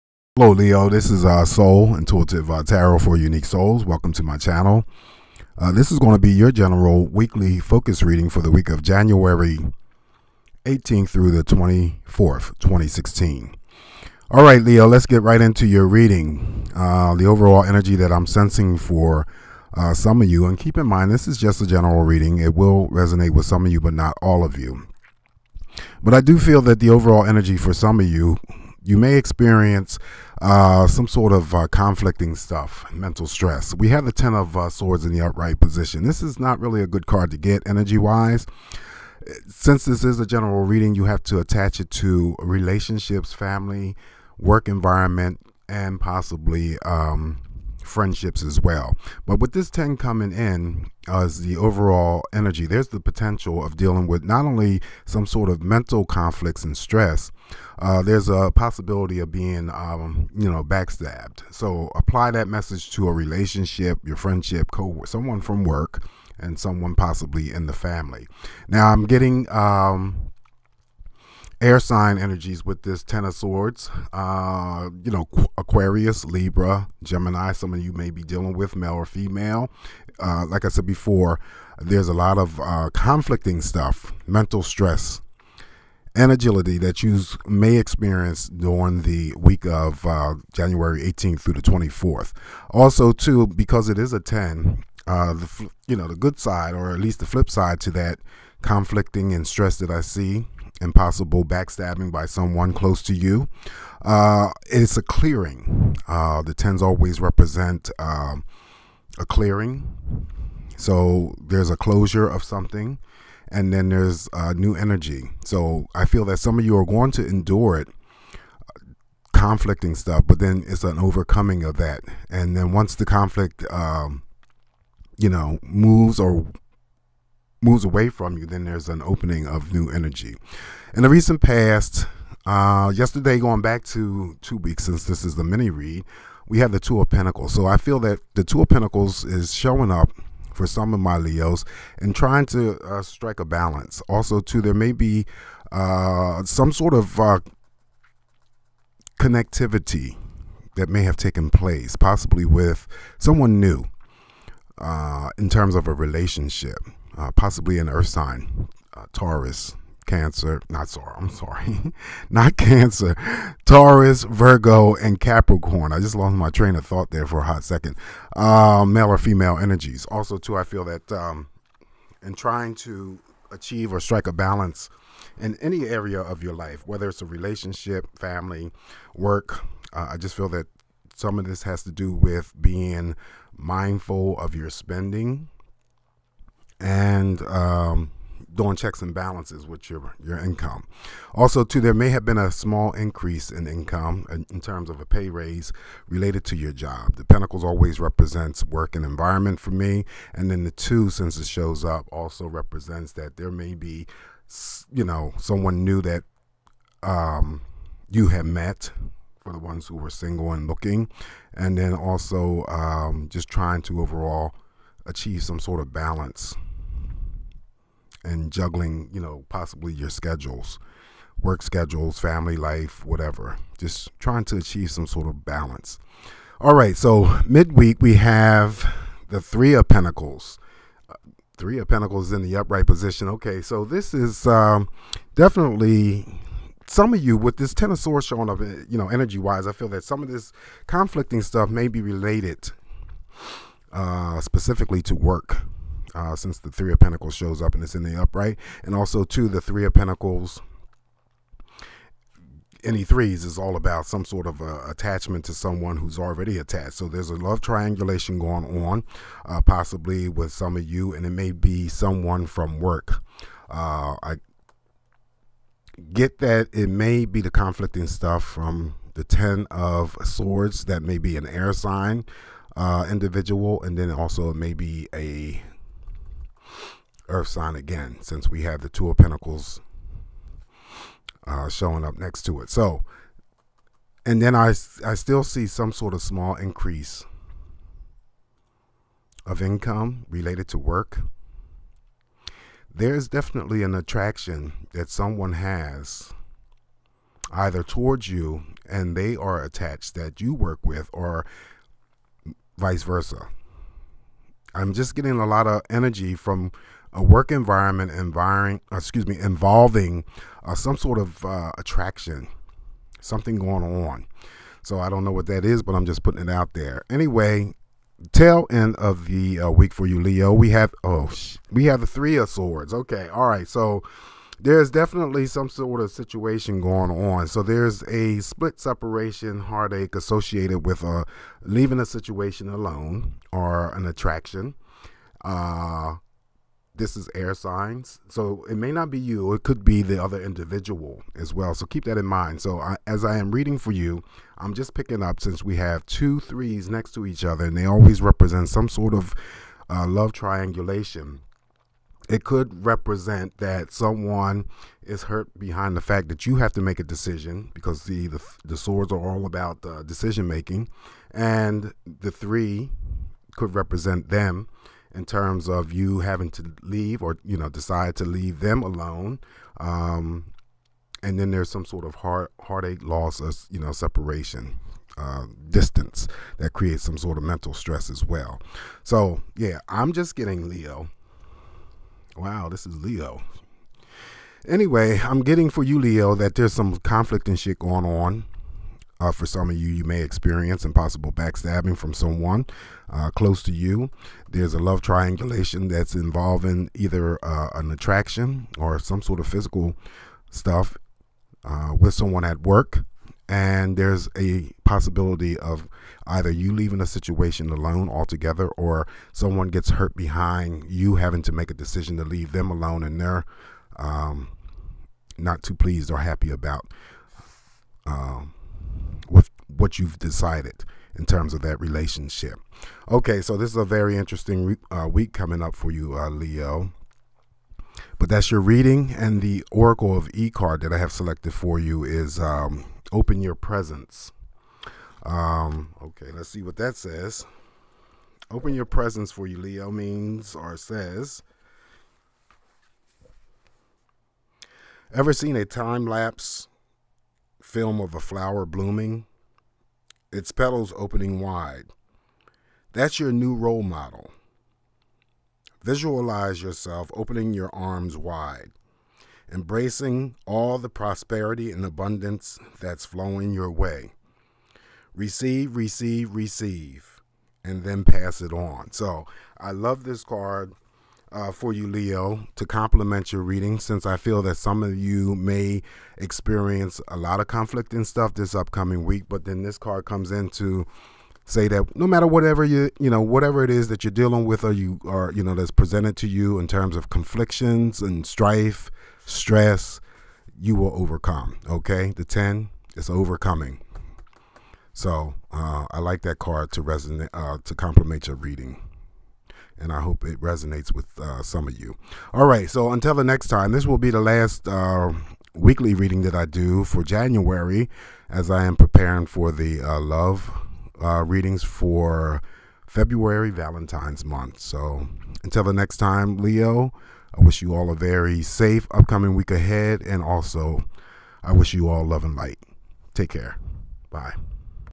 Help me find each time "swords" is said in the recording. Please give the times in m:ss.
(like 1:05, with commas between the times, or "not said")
0:34, 1:13, 3:57, 4:30, 5:22, 5:58.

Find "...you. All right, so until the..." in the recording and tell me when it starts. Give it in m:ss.
8:21.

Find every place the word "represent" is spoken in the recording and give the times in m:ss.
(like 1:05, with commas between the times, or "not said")
1:47, 3:17, 3:22, 5:48, 5:52, 6:03.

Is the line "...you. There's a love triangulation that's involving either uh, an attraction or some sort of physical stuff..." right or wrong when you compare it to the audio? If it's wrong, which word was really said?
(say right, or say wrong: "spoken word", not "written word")
right.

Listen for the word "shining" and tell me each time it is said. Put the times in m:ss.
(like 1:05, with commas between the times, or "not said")
not said.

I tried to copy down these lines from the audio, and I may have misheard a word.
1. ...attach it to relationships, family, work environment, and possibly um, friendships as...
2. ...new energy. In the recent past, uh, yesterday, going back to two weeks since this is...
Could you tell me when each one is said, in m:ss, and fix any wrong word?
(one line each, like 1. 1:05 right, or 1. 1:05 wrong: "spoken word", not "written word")
1. 0:41 right
2. 2:09 right.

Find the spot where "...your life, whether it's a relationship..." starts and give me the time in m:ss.
2:56.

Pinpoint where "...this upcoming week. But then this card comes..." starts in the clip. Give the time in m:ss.
7:58.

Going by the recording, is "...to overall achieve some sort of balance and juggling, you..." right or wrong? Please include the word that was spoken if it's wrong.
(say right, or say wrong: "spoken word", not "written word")
right.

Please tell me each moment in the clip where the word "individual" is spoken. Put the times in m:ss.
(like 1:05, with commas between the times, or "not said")
4:33, 5:40.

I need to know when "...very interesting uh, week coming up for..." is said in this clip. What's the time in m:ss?
7:03.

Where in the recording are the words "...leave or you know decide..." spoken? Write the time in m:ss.
6:06.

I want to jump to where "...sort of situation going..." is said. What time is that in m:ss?
5:25.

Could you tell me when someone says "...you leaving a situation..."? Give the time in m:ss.
6:46.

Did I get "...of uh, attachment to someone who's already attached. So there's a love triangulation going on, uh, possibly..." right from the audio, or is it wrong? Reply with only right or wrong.
right.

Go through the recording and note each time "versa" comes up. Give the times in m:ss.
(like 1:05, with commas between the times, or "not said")
5:03.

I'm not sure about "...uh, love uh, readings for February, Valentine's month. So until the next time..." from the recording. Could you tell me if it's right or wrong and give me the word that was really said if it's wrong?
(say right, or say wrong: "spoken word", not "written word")
right.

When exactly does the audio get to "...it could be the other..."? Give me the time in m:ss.
5:39.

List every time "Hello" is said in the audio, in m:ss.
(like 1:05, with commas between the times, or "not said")
0:00.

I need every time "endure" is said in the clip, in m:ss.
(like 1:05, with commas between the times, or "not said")
1:57.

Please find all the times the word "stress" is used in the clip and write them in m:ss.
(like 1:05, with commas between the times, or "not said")
0:33, 0:56, 1:24, 1:39, 6:17, 8:09.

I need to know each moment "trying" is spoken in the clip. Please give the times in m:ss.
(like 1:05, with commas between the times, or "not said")
2:22, 2:52, 3:33, 3:44.